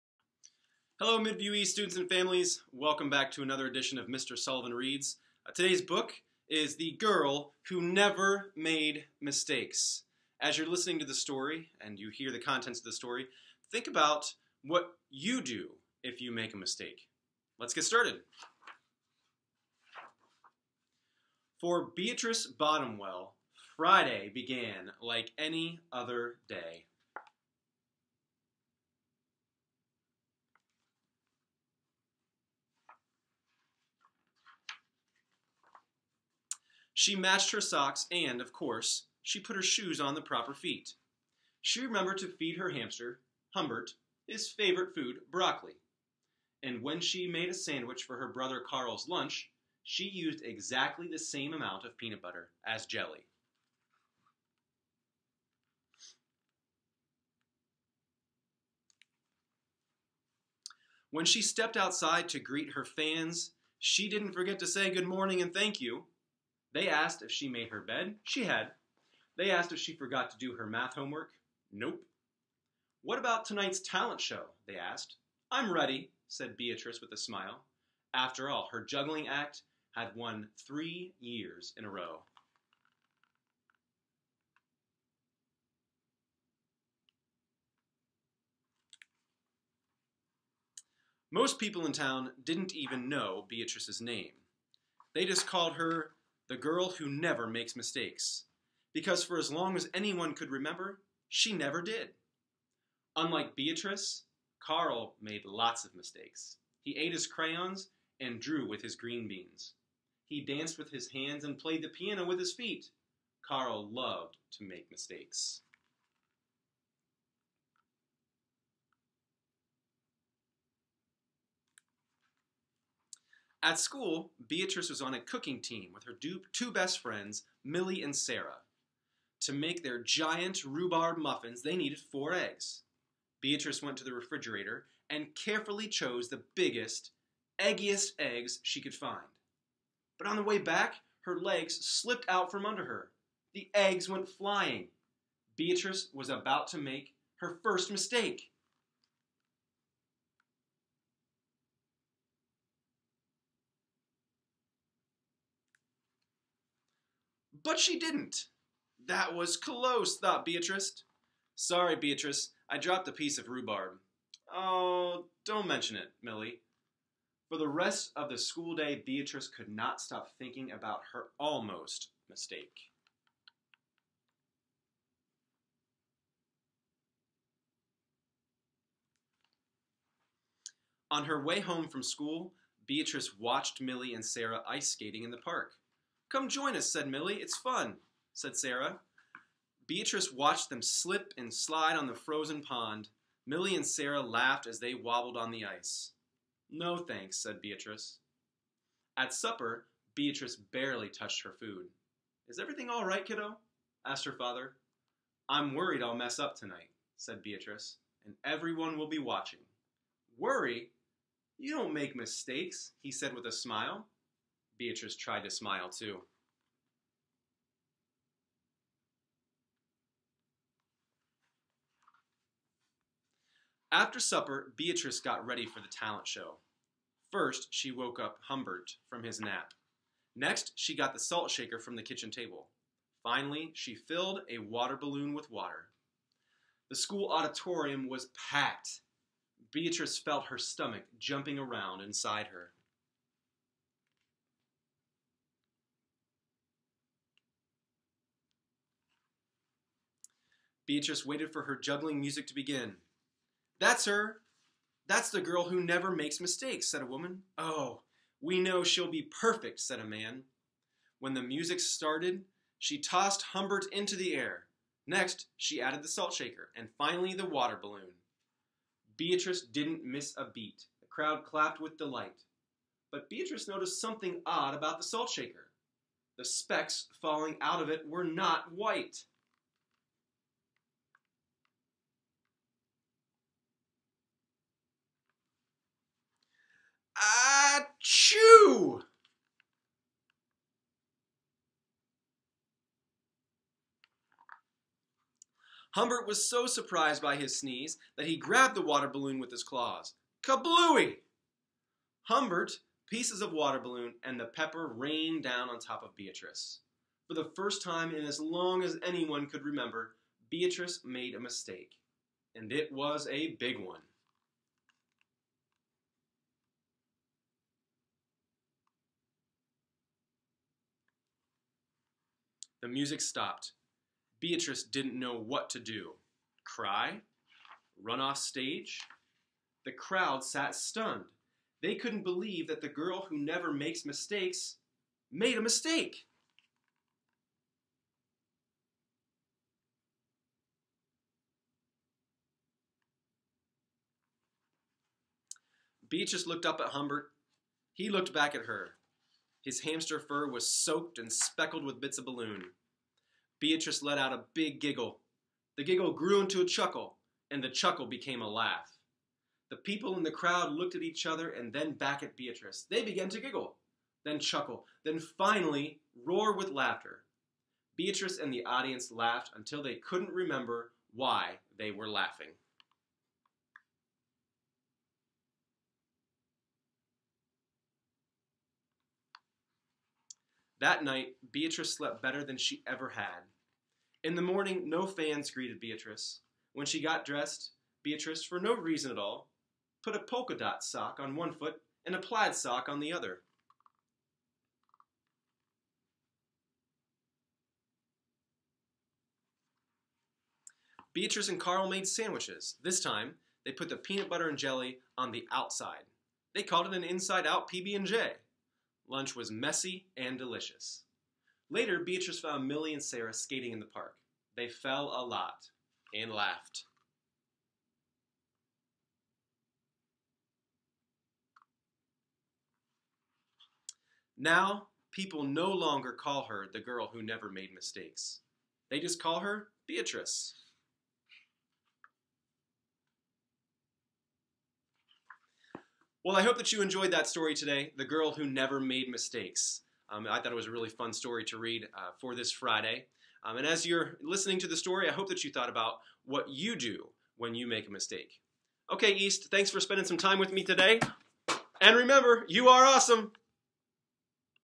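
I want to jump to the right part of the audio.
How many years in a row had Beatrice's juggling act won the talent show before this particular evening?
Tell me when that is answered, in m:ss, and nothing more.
1:20.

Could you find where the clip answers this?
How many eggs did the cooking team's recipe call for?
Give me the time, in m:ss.
2:11.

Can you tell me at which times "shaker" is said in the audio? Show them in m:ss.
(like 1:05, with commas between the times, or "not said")
3:51, 4:26, 4:35.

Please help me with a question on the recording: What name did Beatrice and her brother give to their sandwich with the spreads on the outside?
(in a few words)
inside-out PB&J.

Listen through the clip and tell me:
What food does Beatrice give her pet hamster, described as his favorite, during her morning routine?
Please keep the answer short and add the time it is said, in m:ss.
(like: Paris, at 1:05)
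broccoli, at 0:45.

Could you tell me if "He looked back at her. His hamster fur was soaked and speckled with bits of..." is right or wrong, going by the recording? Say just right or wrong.
right.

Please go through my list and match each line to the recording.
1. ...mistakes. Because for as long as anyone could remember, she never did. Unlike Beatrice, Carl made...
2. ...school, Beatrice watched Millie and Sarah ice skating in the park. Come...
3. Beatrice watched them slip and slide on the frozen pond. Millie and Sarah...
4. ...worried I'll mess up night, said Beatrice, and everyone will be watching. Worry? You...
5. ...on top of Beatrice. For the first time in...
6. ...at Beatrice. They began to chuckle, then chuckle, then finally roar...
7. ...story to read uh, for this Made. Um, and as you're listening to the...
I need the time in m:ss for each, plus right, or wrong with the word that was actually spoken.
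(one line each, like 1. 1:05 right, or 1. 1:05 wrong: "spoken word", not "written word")
1. 1:37 right
2. 3:02 right
3. 3:09 right
4. 3:25 wrong: "tonight", not "night"
5. 5:05 right
6. 6:02 wrong: "giggle", not "chuckle"
7. 7:21 wrong: "Friday", not "Made".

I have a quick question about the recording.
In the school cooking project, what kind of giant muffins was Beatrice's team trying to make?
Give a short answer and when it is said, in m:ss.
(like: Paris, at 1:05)
rhubarb muffins, at 2:10.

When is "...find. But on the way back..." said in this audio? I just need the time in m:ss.
2:18.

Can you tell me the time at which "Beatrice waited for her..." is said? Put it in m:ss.
4:10.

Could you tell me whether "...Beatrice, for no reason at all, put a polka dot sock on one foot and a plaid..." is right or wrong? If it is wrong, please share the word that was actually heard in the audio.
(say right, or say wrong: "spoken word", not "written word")
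right.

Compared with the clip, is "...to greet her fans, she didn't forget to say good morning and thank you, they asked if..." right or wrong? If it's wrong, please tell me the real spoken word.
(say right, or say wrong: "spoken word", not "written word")
right.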